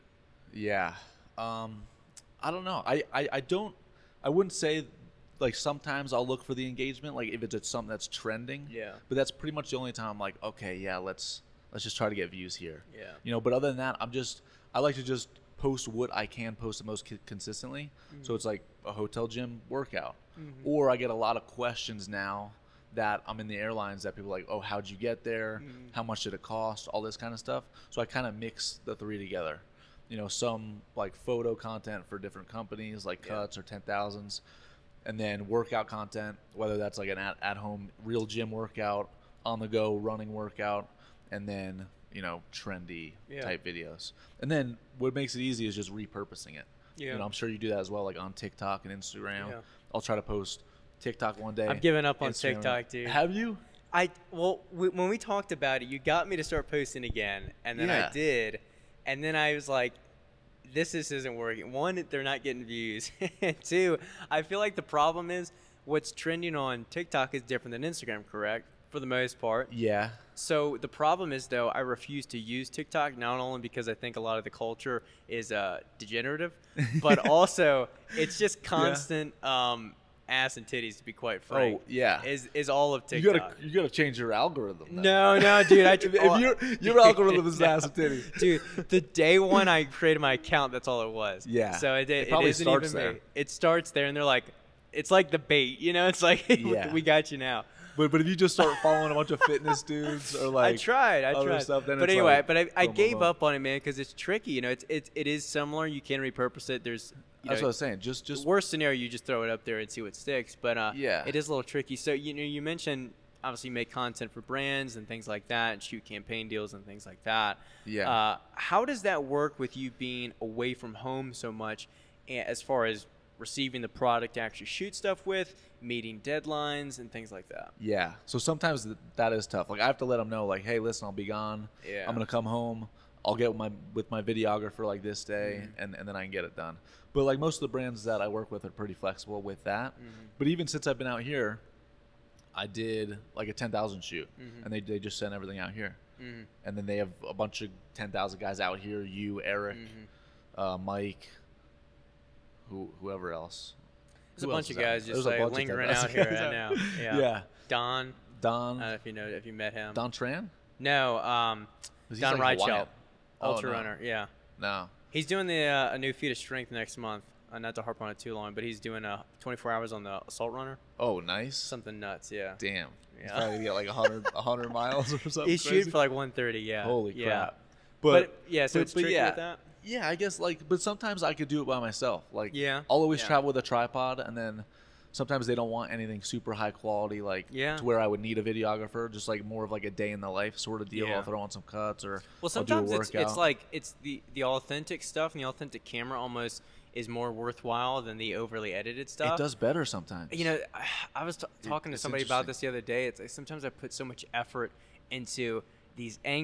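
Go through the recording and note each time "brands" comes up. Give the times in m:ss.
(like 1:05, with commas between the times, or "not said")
1:54, 2:17.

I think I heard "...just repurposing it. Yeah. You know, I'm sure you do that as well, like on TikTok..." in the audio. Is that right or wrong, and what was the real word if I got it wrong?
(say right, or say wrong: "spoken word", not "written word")
right.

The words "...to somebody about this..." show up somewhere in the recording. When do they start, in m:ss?
3:21.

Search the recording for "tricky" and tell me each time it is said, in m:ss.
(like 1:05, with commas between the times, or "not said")
1:44, 1:51, 2:58.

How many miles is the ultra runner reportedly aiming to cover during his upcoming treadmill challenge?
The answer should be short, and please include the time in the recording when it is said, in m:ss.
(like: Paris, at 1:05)
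130, at 2:56.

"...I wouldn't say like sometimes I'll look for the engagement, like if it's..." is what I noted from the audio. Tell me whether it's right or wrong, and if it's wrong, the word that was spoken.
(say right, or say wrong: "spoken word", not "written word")
right.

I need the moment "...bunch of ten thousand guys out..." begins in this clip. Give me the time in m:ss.
2:27.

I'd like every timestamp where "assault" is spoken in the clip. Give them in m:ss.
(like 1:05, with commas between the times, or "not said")
2:50.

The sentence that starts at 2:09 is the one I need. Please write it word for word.
Like I have to let them know, like, hey, listen, I'll be gone.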